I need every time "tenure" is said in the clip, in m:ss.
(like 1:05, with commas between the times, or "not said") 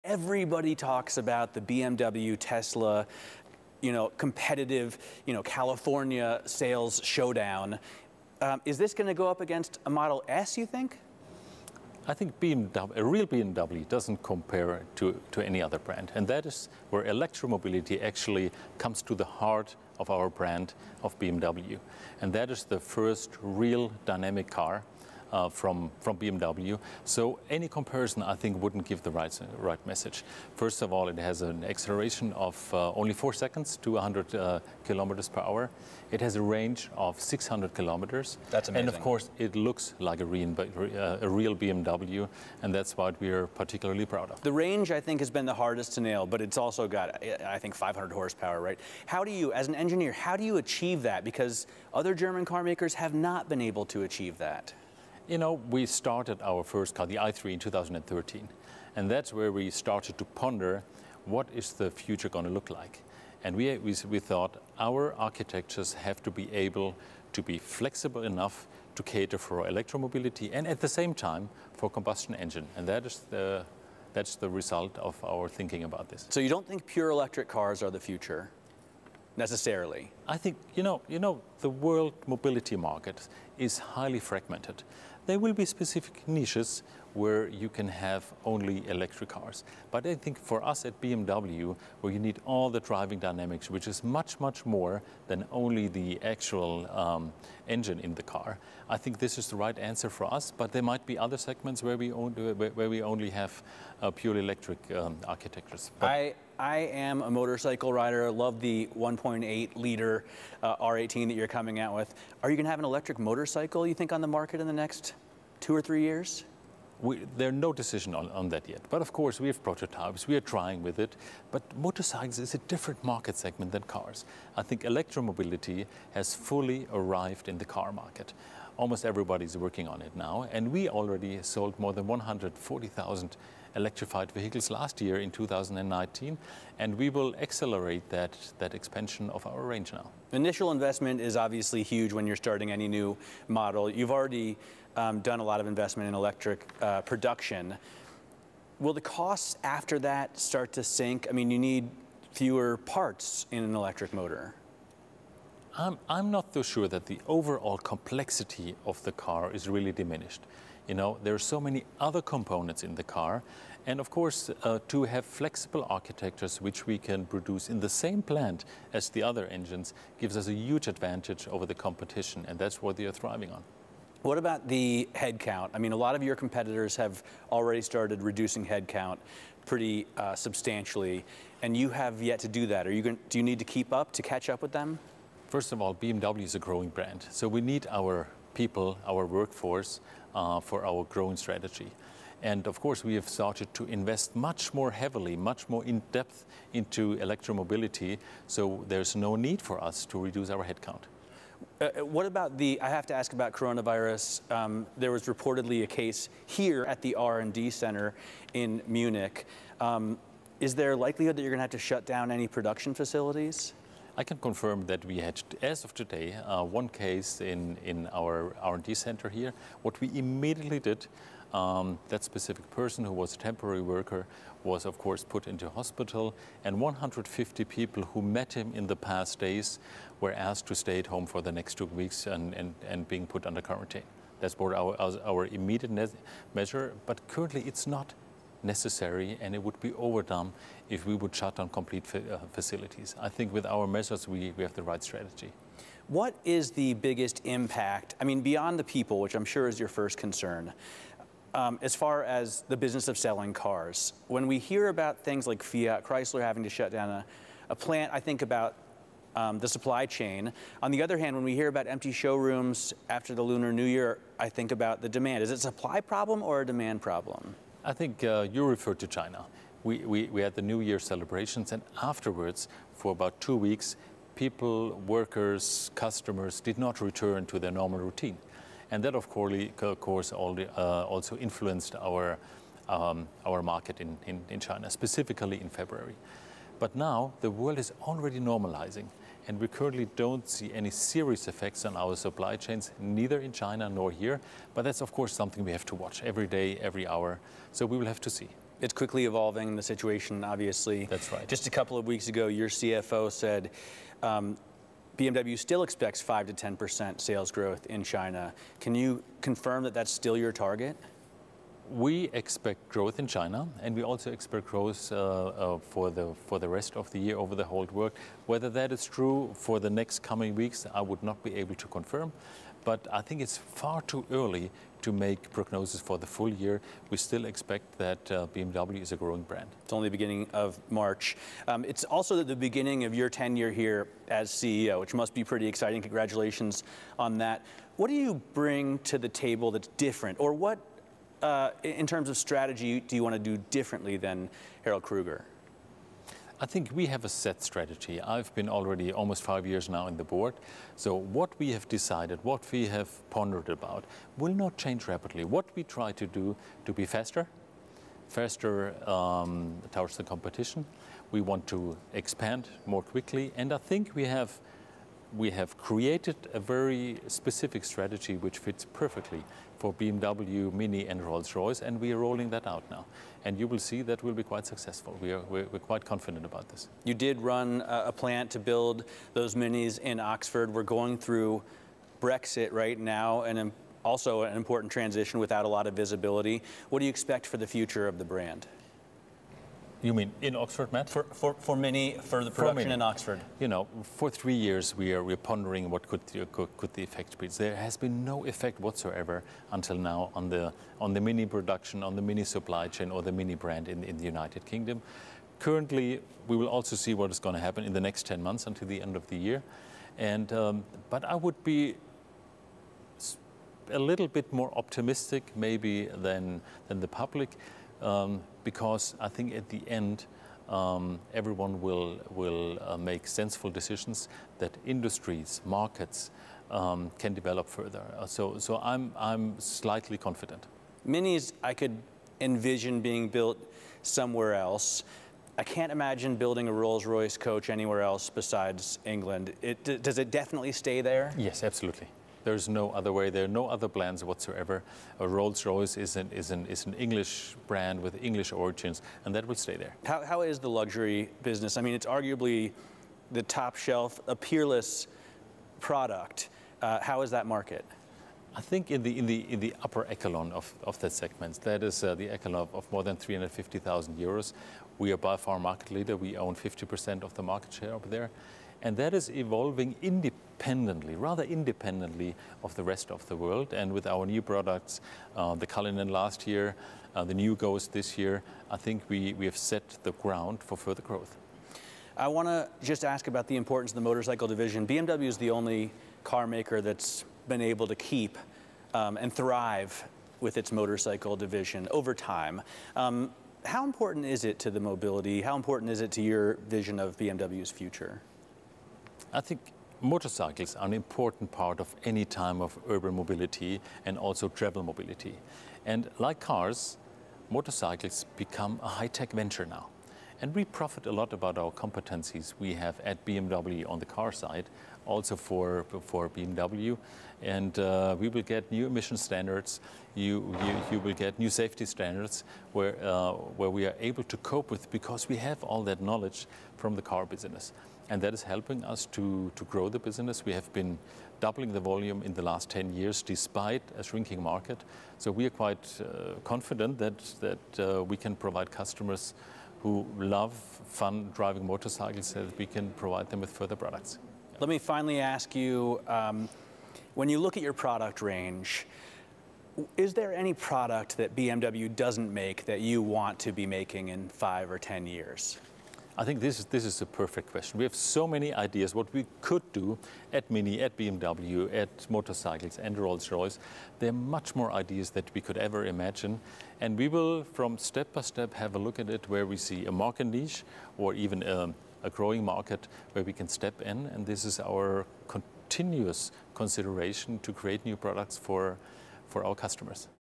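5:33.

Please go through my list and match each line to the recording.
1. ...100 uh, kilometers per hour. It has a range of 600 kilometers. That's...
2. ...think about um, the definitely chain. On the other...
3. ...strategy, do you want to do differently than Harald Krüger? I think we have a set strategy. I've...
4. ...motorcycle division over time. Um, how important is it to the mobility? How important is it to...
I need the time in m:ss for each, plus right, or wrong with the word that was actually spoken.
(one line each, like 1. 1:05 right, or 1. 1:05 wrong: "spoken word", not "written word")
1. 0:33 right
2. 4:18 wrong: "supply", not "definitely"
3. 5:42 right
4. 8:10 right.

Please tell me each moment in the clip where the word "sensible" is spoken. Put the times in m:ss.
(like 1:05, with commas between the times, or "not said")
7:03.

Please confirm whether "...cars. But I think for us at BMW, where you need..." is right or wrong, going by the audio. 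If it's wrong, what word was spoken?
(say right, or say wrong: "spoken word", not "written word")
right.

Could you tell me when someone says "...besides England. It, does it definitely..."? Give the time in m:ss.
7:18.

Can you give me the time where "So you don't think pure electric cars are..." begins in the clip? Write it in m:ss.
1:16.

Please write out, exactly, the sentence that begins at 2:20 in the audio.
Initial investment is obviously huge when you're starting any new model.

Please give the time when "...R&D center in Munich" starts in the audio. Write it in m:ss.
3:27.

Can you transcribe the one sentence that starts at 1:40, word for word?
But there might be other segments where we, where we only have uh, purely electric um, architectures.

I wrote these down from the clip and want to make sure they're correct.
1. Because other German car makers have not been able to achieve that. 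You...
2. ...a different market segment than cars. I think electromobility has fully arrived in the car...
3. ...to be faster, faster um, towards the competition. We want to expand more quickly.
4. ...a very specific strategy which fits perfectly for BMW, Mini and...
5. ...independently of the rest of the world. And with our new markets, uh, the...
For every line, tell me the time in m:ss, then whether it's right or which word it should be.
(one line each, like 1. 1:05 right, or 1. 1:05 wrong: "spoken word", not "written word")
1. 0:51 right
2. 2:02 right
3. 5:56 right
4. 6:06 right
5. 7:51 wrong: "products", not "markets".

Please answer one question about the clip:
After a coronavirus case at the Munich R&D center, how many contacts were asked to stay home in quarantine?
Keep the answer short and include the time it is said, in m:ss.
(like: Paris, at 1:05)
150, at 3:46.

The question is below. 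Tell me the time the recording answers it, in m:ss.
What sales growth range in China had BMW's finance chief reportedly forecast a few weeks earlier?
5:06.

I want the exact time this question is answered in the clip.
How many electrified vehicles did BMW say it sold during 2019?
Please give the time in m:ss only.
2:12.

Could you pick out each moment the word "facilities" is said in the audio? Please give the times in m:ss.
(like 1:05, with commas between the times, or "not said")
3:32, 4:02.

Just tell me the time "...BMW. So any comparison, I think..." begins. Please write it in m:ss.
0:26.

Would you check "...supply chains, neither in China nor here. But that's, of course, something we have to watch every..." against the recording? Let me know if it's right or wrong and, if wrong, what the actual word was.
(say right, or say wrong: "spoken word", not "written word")
right.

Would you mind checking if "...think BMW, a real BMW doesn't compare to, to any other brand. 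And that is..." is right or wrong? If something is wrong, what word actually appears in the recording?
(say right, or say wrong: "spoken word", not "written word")
right.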